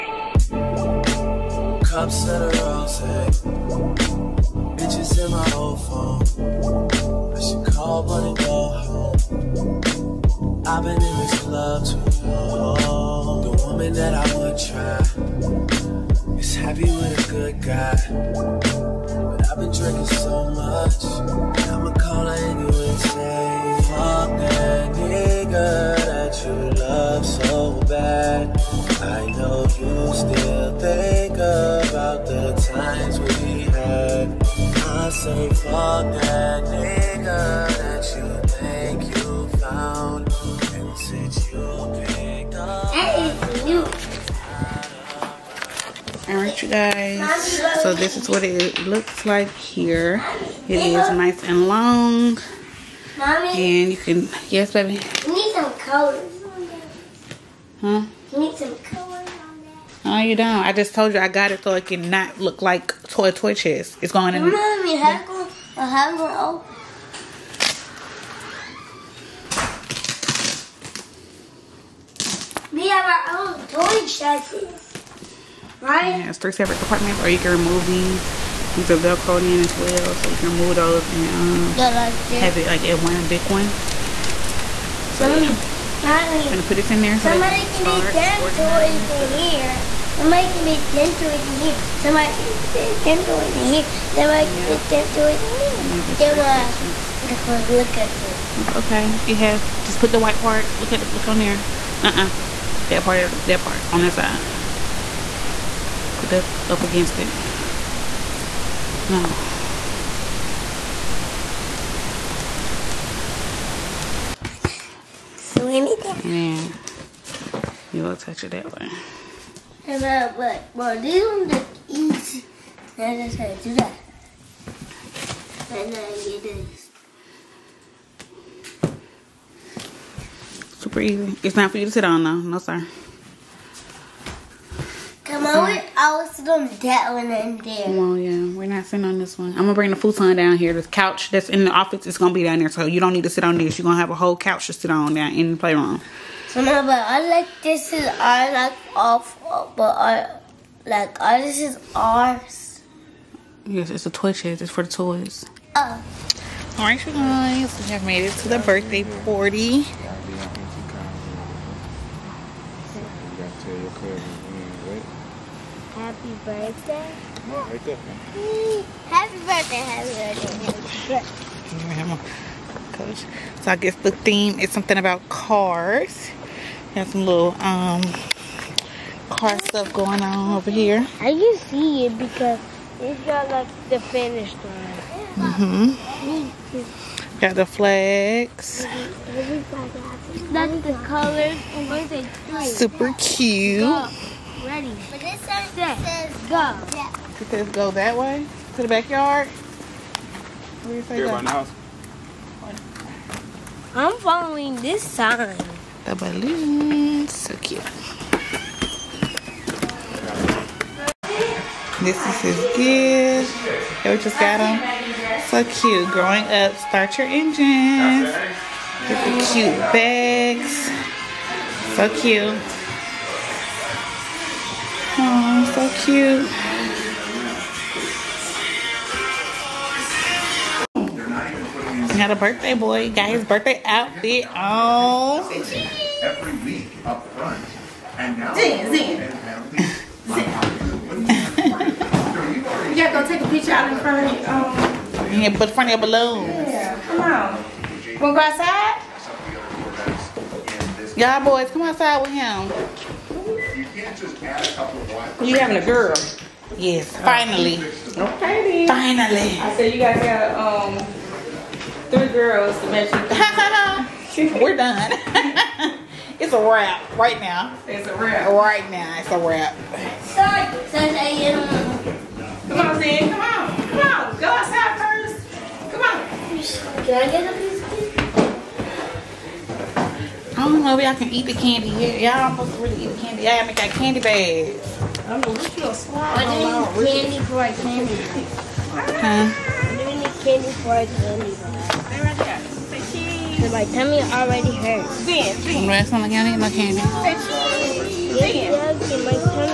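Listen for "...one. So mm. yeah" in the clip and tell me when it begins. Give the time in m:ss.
1:23.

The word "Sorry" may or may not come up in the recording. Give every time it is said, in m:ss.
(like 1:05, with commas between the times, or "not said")
4:30.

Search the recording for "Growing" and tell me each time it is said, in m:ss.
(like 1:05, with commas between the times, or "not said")
3:36.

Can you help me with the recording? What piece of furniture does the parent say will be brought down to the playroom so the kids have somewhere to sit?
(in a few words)
futon.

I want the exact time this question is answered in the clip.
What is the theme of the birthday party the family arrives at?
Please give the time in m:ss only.
2:55.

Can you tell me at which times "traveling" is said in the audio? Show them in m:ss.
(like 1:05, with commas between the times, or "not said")
not said.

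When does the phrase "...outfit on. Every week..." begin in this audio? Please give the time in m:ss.
3:53.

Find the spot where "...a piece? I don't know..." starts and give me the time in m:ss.
4:37.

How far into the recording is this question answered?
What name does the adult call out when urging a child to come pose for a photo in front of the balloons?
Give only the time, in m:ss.
4:32.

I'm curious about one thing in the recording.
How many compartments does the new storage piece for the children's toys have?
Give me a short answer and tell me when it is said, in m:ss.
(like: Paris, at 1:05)
3, at 1:16.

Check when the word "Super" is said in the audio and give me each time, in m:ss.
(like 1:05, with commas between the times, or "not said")
2:10, 3:12.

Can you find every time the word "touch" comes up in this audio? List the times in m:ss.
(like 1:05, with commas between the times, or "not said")
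1:58.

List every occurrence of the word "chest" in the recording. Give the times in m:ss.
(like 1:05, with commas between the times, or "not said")
1:03, 1:14, 2:34.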